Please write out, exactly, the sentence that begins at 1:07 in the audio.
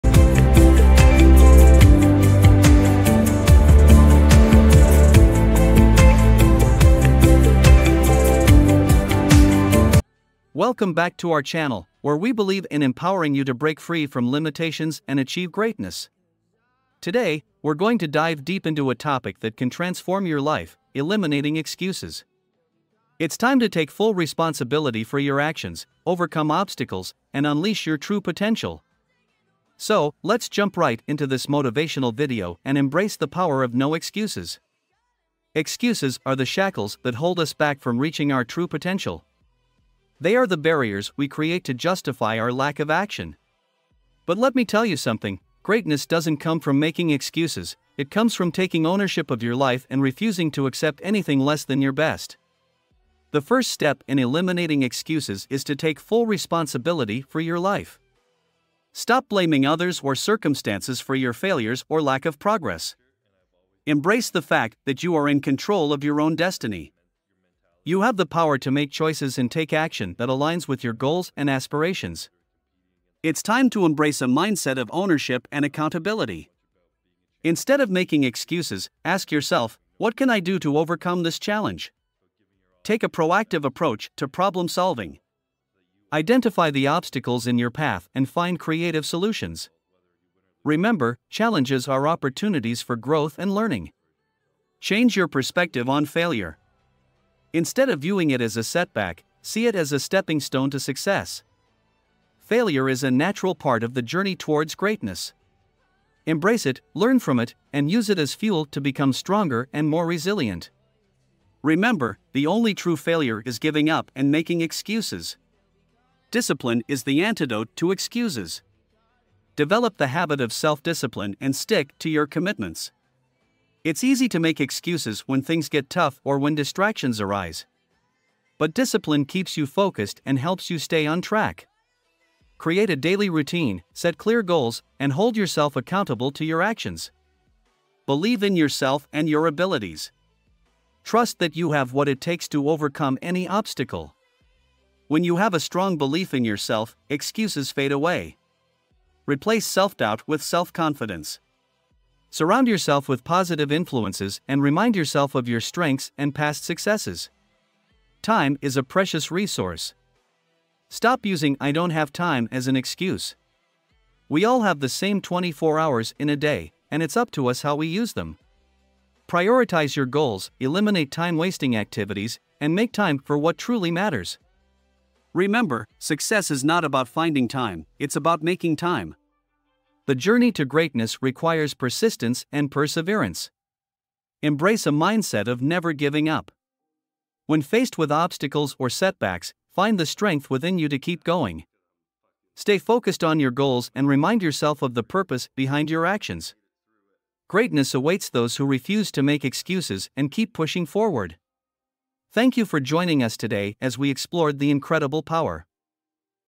You have the power to make choices and take action that aligns with your goals and aspirations.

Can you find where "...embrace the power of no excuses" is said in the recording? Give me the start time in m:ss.
0:32.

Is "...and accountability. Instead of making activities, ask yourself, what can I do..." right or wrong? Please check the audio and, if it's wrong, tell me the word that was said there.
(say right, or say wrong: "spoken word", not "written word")
wrong: "excuses", not "activities".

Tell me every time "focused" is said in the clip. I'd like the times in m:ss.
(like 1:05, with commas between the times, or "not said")
2:09, 3:12.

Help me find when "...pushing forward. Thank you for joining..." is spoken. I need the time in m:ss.
3:20.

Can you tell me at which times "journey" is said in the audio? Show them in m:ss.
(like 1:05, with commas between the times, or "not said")
1:44, 3:00.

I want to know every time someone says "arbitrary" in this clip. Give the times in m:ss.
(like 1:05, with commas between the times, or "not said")
not said.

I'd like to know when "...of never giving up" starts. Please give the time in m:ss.
3:05.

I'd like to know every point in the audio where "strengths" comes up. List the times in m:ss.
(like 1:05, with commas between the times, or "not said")
2:35, 3:10.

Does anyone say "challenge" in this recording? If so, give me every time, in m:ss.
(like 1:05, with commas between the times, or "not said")
1:21, 1:31.